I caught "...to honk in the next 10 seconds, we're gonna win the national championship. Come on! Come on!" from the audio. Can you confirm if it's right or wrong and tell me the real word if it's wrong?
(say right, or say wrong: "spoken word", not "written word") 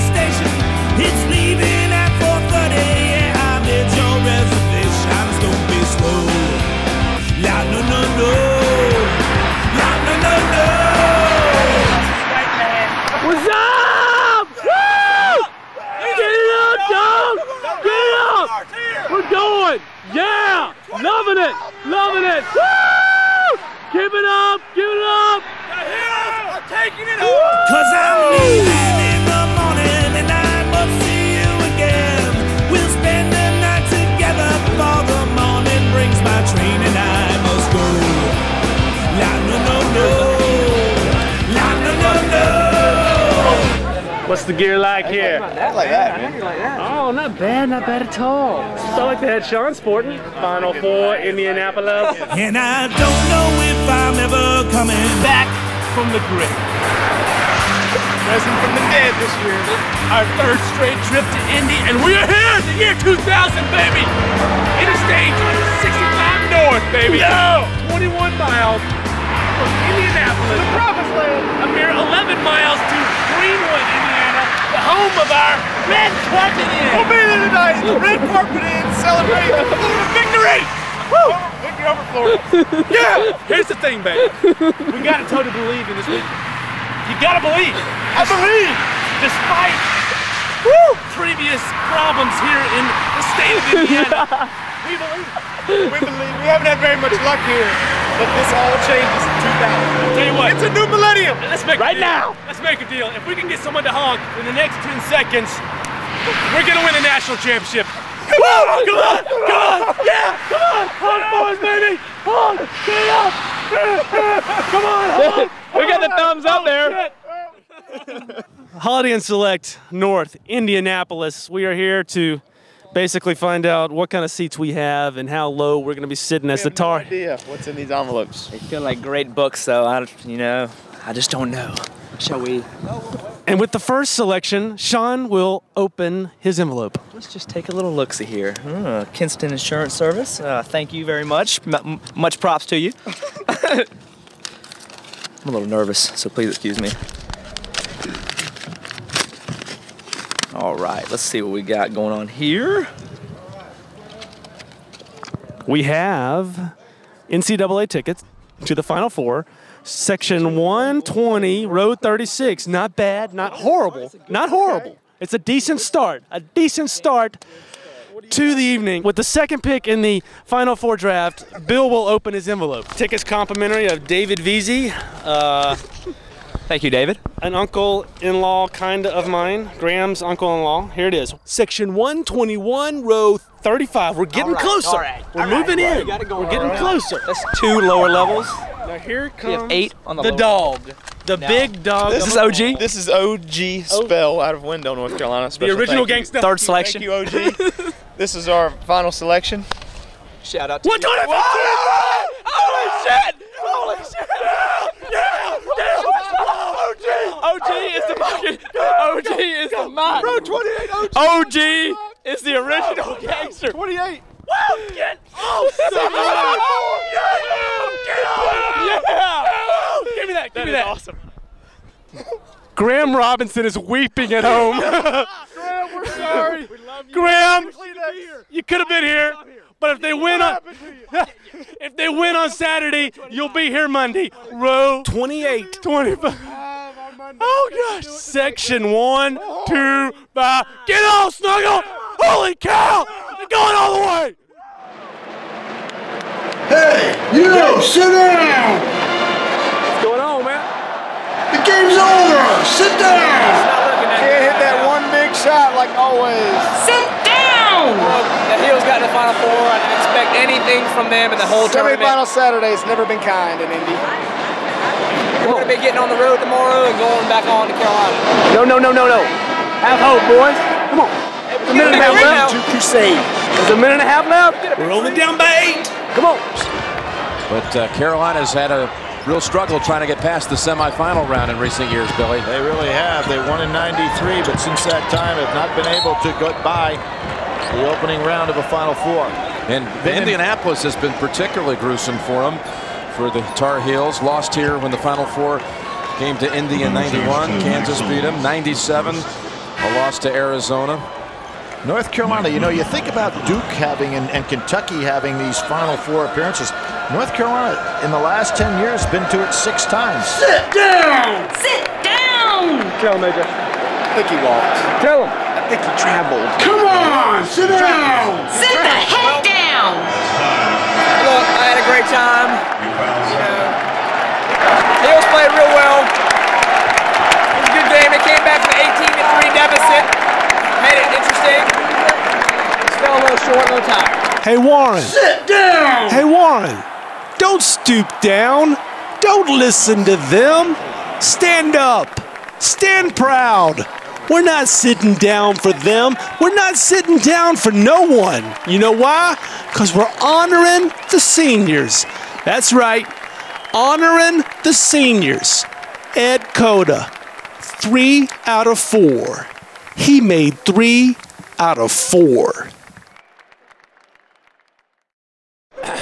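right.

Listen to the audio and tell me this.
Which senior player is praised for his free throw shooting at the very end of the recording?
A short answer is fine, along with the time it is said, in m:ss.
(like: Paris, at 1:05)
Ed Cota, at 5:56.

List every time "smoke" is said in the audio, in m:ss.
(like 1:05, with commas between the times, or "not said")
not said.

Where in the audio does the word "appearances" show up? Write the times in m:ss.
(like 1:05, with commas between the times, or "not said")
5:06.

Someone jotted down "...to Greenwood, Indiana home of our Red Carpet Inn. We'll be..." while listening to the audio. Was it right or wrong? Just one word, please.
right.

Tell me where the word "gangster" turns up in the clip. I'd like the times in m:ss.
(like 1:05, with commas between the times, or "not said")
3:16, 3:33.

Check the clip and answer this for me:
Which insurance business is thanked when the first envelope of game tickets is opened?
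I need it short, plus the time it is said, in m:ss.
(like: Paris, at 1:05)
Kinston Insurance Service, at 2:19.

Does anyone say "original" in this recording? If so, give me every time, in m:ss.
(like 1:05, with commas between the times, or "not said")
3:15, 3:32.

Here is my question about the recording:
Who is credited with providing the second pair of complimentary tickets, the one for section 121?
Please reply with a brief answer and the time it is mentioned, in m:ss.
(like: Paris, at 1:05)
David Veazey, at 2:54.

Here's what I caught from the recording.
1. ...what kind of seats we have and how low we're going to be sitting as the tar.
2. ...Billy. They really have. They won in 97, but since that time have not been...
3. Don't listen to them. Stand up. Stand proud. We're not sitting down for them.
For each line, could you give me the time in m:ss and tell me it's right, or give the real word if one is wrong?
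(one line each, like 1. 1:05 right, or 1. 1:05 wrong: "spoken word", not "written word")
1. 2:03 right
2. 4:42 wrong: "93", not "97"
3. 5:39 right.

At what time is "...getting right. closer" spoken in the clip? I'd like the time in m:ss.
3:06.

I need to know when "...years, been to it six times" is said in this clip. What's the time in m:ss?
5:08.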